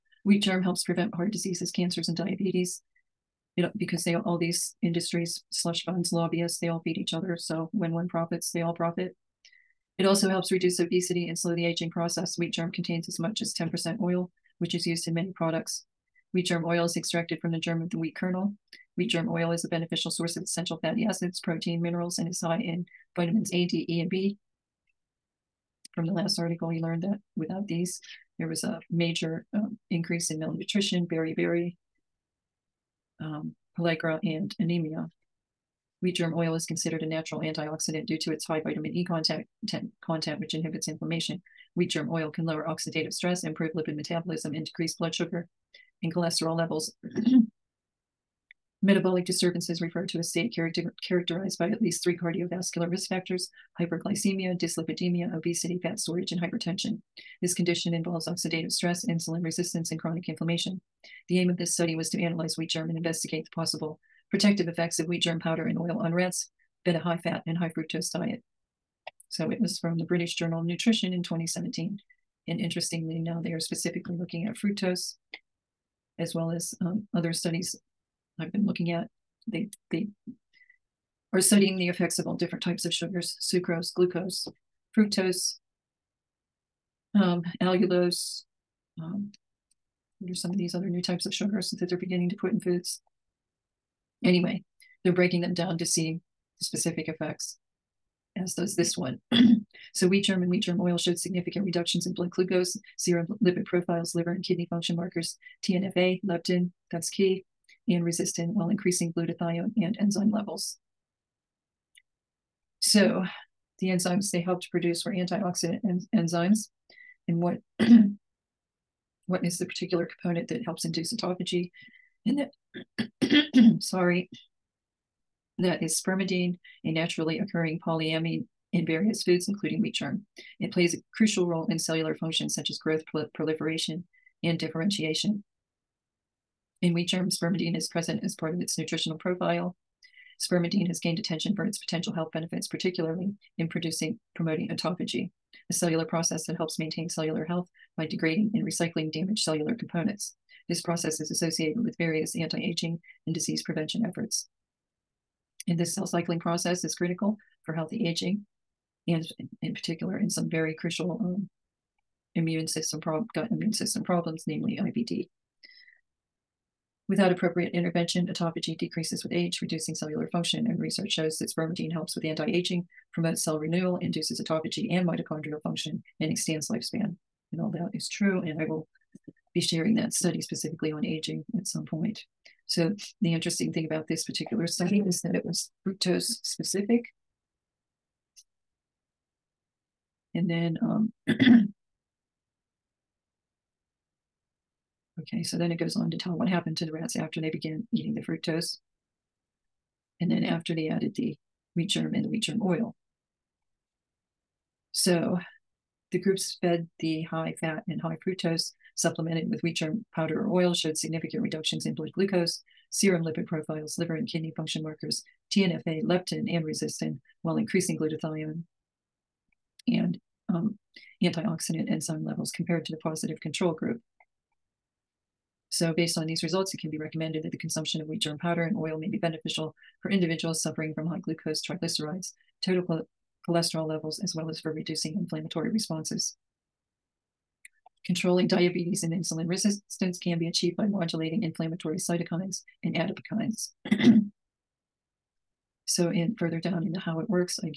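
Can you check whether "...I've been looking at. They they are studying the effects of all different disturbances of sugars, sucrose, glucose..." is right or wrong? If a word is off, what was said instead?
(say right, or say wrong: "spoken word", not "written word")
wrong: "types", not "disturbances".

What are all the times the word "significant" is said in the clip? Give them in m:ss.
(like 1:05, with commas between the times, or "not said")
1:41, 3:30.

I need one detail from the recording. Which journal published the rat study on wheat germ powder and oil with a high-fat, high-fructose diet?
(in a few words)
British Journal of Nutrition.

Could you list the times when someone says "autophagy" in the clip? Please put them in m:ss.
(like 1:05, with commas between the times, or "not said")
2:01, 2:24, 2:48, 2:54.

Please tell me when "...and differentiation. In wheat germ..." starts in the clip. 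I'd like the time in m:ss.
2:14.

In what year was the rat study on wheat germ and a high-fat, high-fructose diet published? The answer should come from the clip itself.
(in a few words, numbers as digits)
2017.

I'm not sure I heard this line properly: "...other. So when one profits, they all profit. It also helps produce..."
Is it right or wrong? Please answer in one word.
wrong.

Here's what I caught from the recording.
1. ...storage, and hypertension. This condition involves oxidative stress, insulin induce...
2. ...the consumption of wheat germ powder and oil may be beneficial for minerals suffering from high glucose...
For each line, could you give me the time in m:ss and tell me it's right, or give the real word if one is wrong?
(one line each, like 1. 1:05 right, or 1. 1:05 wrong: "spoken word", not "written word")
1. 0:55 wrong: "resistance", not "induce"
2. 3:47 wrong: "individuals", not "minerals".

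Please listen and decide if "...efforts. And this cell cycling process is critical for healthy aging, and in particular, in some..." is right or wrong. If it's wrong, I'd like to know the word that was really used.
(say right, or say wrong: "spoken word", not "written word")
right.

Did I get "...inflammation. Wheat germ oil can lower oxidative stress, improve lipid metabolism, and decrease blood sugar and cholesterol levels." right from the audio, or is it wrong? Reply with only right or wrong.
right.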